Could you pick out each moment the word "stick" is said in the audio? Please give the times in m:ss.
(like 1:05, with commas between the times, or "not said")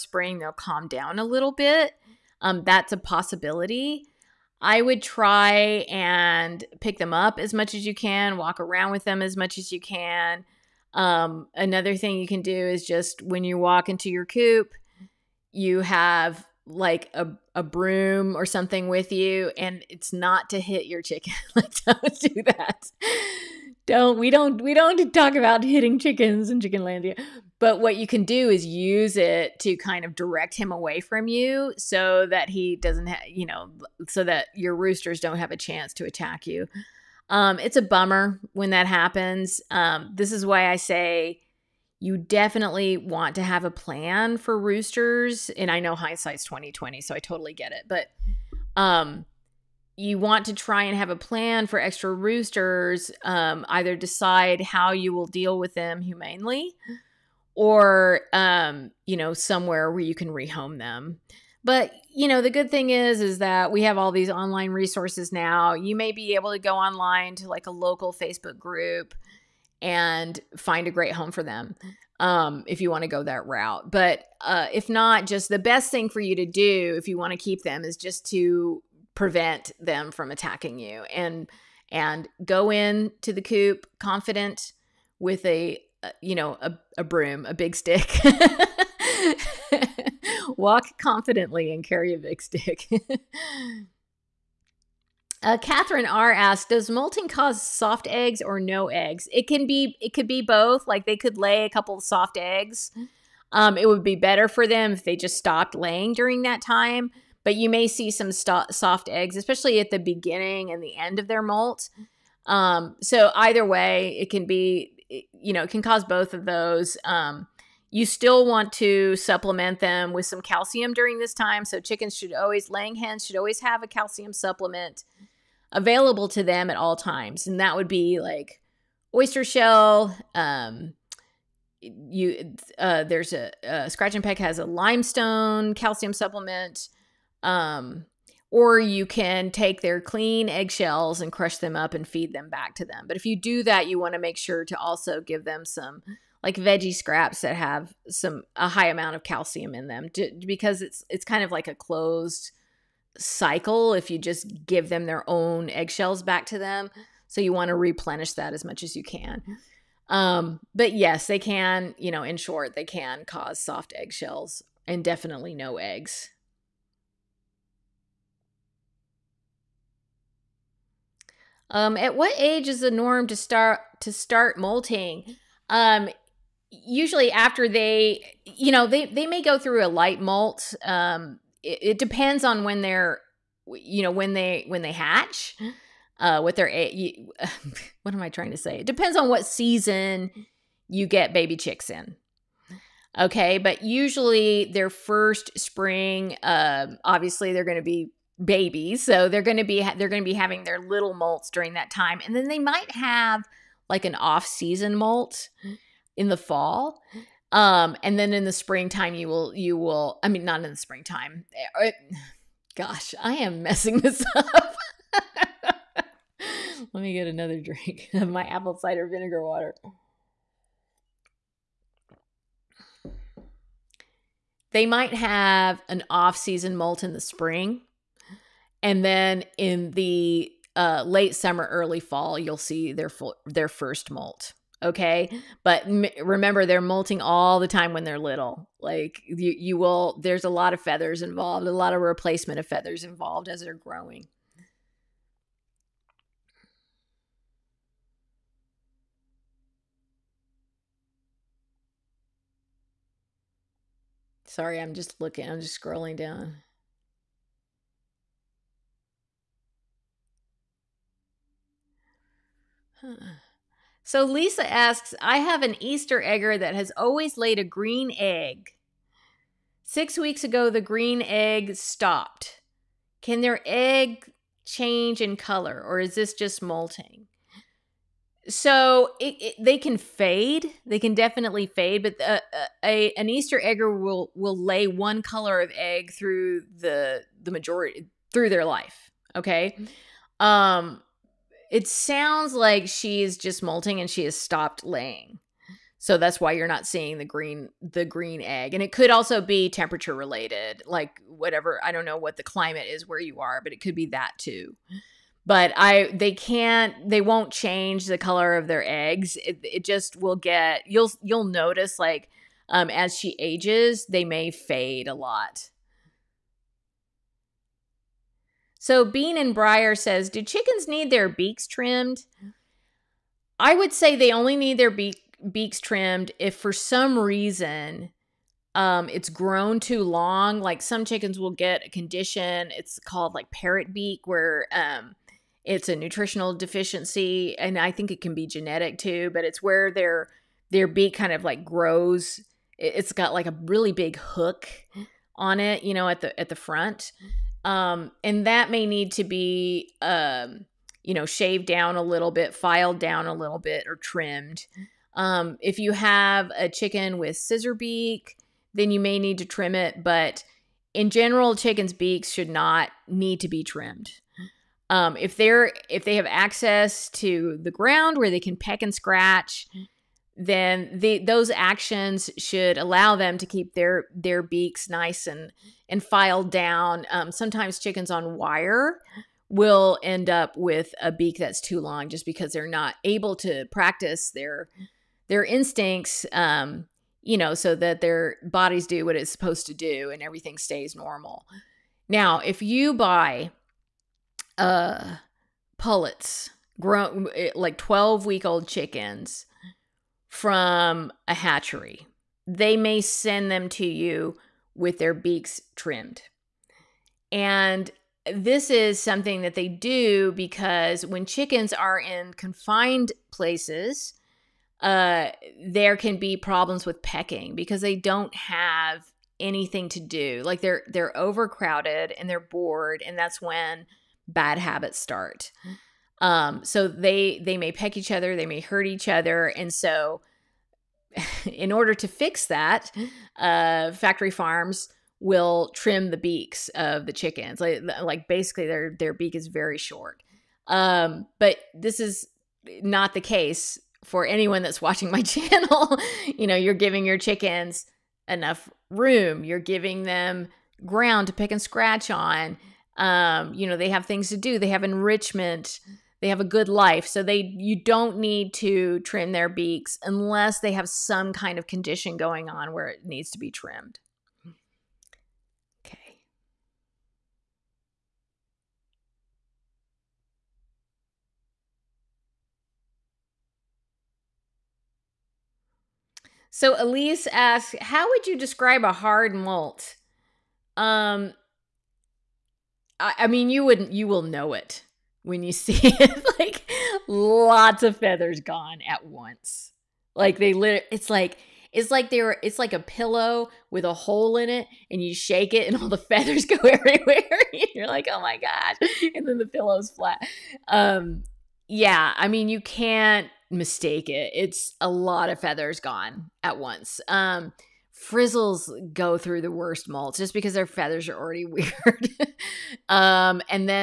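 1:27, 1:32.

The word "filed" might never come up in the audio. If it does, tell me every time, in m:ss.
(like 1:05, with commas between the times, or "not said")
5:52, 6:16.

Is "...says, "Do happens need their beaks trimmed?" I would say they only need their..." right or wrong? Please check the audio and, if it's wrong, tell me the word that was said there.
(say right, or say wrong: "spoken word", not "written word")
wrong: "chickens", not "happens".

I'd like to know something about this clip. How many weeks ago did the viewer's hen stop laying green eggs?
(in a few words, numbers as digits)
6.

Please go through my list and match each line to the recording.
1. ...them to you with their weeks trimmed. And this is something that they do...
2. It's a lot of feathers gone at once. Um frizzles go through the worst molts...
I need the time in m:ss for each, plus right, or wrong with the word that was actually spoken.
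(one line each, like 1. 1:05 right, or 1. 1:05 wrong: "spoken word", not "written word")
1. 6:43 wrong: "beaks", not "weeks"
2. 8:24 right.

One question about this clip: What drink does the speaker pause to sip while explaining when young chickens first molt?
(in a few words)
apple cider vinegar water.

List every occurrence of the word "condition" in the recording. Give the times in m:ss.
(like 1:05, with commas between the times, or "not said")
5:31, 7:41.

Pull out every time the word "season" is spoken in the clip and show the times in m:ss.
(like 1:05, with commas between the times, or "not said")
3:09, 3:24, 3:46.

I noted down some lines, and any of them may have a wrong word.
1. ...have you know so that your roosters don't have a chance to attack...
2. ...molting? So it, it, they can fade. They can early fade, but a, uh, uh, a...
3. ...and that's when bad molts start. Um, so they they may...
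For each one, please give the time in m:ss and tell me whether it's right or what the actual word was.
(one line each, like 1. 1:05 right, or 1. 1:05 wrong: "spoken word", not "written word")
1. 0:33 right
2. 4:36 wrong: "definitely", not "early"
3. 7:03 wrong: "habits", not "molts".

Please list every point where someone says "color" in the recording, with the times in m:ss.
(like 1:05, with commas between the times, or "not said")
4:35, 4:45, 5:08.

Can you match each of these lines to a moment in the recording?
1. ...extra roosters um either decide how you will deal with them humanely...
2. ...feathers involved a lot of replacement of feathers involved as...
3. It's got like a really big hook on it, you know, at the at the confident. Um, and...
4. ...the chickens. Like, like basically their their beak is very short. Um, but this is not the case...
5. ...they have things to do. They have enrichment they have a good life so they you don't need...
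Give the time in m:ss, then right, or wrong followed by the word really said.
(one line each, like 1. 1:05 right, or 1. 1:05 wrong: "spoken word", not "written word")
1. 0:51 right
2. 4:00 right
3. 5:42 wrong: "front", not "confident"
4. 7:17 right
5. 7:33 right.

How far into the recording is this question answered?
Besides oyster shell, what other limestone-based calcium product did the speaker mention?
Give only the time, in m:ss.
2:14.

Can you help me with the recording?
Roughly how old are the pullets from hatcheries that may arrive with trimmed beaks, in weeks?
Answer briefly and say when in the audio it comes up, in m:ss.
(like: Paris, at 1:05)
12, at 6:37.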